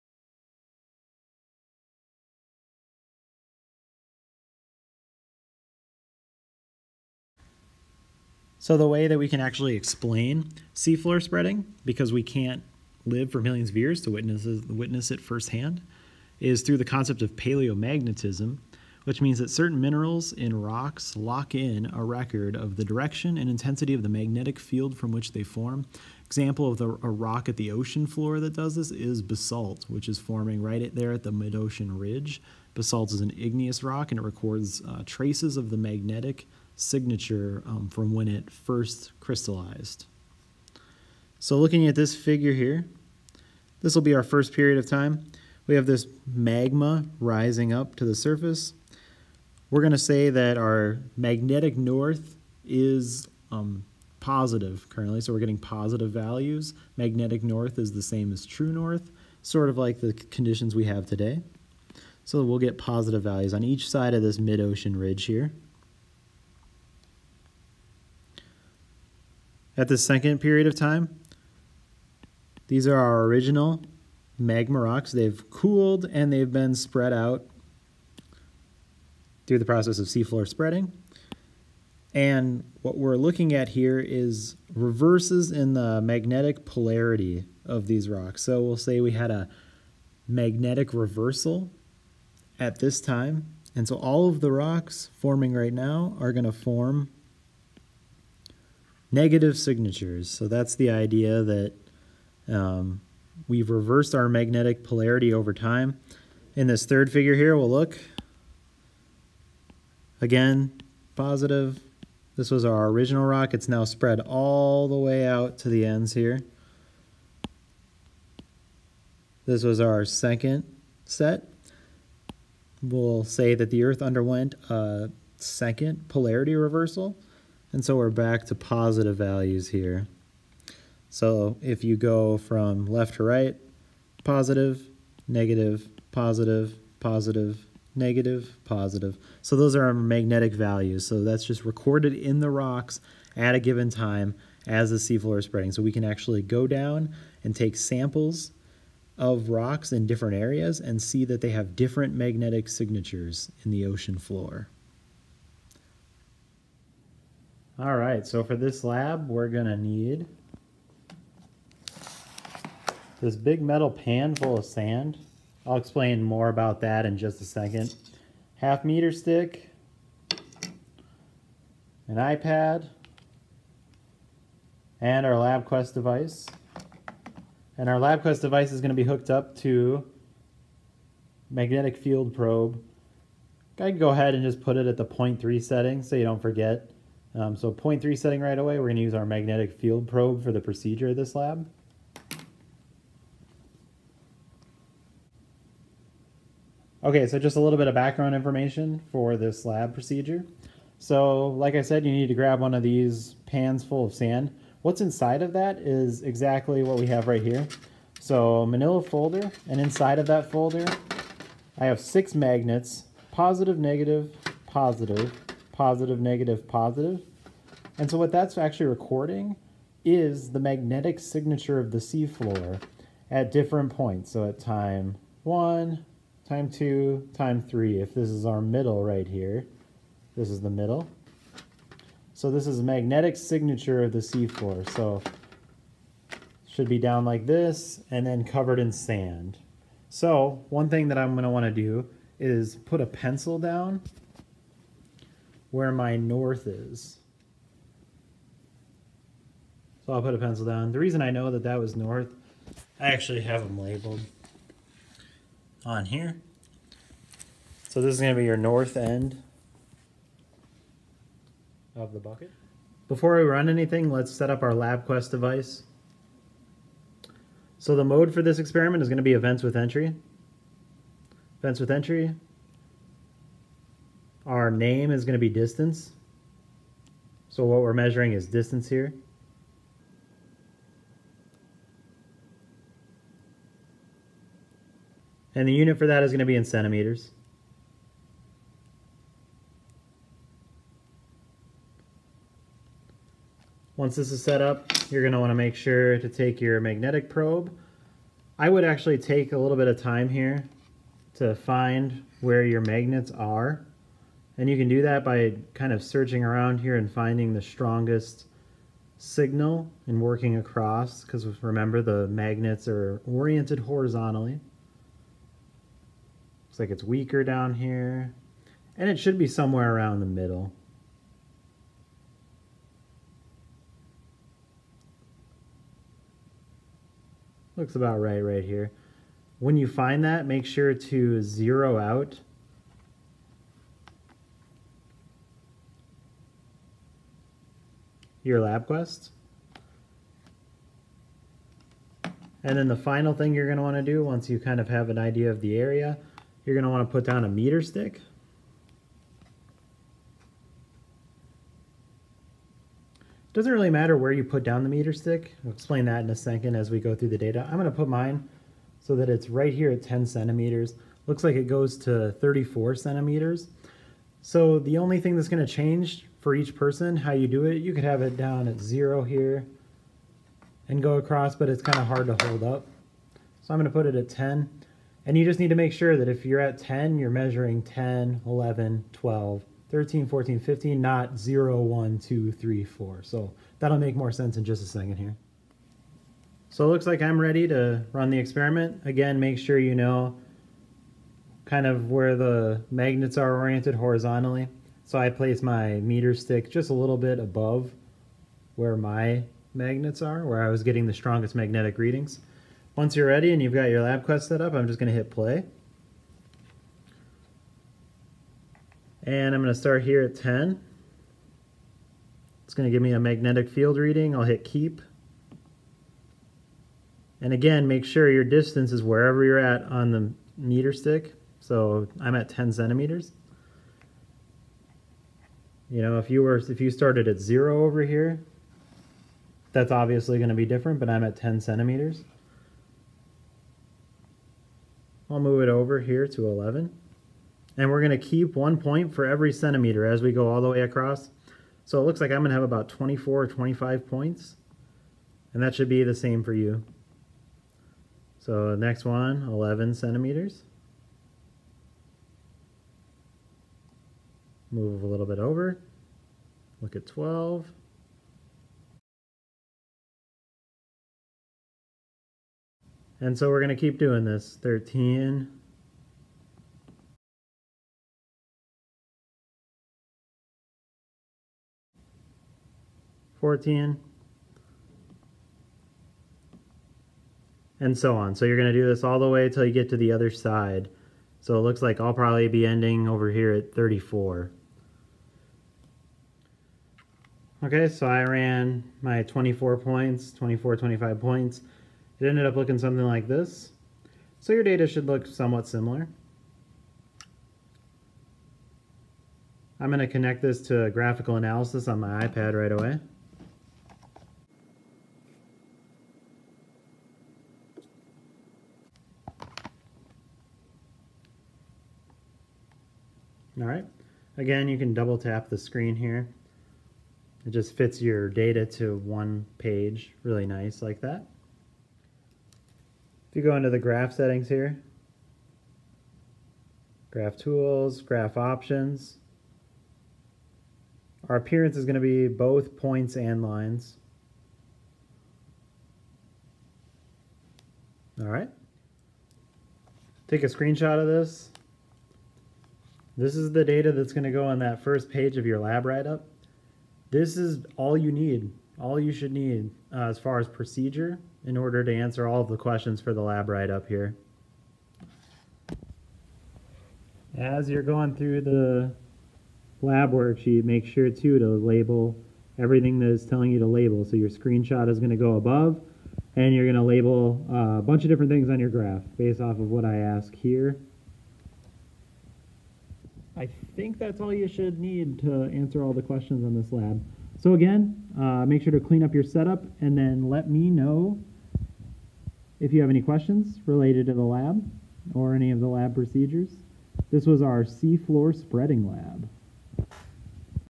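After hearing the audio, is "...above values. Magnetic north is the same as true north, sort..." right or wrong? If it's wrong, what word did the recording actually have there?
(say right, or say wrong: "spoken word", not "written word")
wrong: "positive", not "above".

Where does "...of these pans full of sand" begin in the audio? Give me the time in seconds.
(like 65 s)
202 s.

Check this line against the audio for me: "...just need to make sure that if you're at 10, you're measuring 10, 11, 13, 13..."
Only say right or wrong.
wrong.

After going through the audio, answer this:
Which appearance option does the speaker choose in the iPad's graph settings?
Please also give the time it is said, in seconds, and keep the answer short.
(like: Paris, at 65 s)
Both points and lines, at 532 s.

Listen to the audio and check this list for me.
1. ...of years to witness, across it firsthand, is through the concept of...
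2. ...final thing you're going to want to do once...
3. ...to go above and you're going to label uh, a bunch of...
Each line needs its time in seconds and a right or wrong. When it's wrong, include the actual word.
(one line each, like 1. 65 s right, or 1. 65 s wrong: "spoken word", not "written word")
1. 13 s wrong: "witness", not "across"
2. 342 s right
3. 565 s right.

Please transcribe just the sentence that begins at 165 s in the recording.
I'll explain more about that in just a second.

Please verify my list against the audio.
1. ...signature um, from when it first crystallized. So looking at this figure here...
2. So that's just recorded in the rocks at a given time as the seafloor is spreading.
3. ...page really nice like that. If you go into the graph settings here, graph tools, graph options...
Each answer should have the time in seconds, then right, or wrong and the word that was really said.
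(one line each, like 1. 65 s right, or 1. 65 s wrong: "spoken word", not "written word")
1. 36 s right
2. 141 s right
3. 519 s right.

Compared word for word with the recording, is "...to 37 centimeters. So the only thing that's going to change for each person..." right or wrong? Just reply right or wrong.
wrong.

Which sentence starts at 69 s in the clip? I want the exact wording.
at the second period of time.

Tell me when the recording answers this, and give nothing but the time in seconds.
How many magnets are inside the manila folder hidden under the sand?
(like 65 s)
211 s.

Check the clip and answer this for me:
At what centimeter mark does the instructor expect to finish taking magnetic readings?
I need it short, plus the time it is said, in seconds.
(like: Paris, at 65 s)
34, at 482 s.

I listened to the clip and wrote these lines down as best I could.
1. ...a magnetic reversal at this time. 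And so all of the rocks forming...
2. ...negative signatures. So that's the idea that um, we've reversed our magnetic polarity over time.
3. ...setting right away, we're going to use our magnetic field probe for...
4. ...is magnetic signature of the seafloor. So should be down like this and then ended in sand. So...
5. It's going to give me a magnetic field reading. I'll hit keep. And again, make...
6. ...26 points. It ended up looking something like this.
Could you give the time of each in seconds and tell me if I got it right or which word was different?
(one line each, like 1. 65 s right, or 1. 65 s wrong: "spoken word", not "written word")
1. 89 s right
2. 99 s right
3. 188 s right
4. 232 s wrong: "covered", not "ended"
5. 412 s right
6. 490 s wrong: "25", not "26".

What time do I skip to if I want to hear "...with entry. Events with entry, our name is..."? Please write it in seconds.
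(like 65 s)
269 s.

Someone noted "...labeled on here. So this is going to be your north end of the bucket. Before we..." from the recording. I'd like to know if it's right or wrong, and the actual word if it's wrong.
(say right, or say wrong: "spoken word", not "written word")
right.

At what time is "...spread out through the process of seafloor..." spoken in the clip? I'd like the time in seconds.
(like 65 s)
76 s.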